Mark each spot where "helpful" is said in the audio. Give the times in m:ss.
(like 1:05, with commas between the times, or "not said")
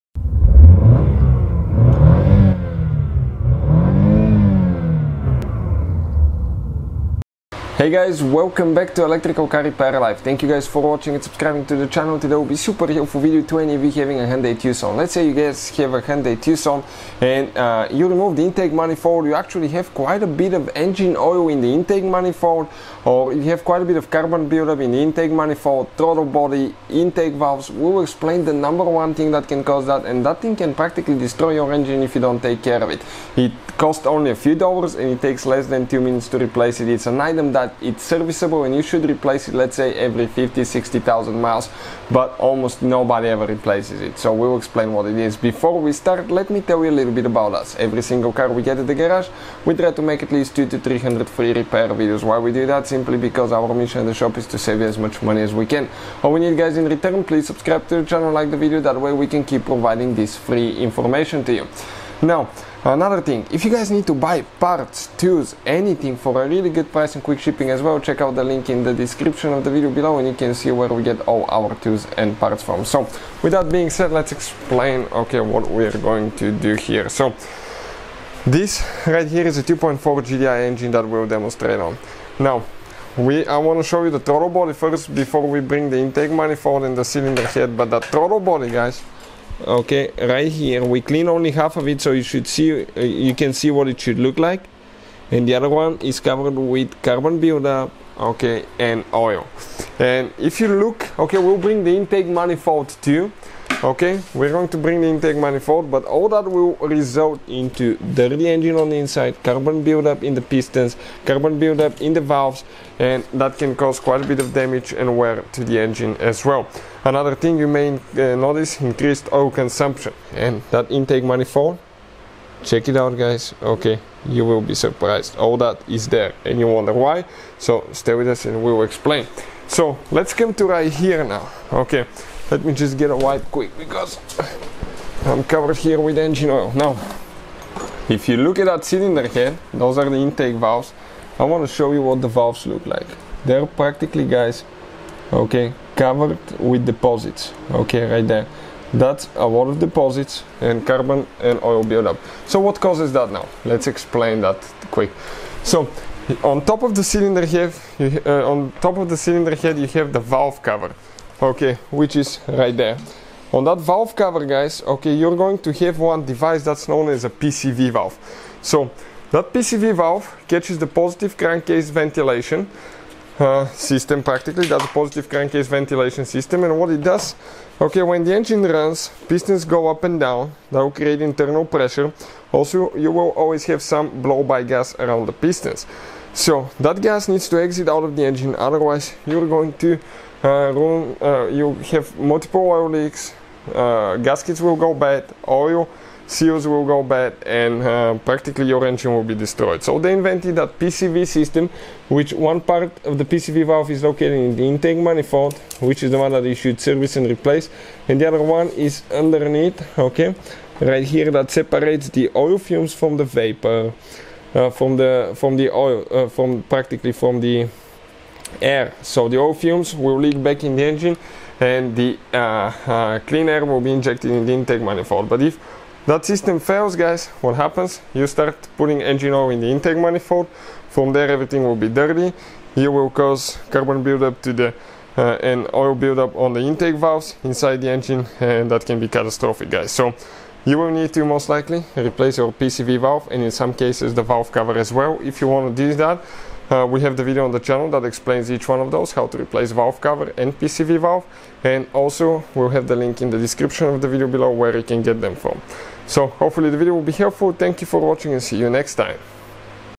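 0:12, 4:17.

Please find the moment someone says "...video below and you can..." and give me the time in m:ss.
1:09.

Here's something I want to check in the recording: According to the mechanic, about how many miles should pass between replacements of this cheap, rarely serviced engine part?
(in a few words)
every 50, 60,000 miles.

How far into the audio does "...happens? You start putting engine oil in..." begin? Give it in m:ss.
3:47.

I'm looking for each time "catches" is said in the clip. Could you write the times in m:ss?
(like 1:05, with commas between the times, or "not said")
2:50.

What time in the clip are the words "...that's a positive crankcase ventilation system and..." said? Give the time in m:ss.
2:54.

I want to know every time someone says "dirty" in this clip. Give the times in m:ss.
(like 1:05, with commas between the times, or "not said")
1:48, 3:51.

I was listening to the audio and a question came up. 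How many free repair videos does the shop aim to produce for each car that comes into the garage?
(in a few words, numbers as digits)
2 to 300.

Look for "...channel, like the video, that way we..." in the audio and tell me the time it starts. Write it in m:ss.
0:58.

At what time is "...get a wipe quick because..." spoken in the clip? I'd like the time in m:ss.
2:12.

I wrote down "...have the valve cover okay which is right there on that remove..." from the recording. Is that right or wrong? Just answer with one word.
wrong.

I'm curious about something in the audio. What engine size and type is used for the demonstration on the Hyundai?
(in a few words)
2.4 GDI.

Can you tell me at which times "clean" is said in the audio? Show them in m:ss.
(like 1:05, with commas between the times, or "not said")
1:31, 3:43.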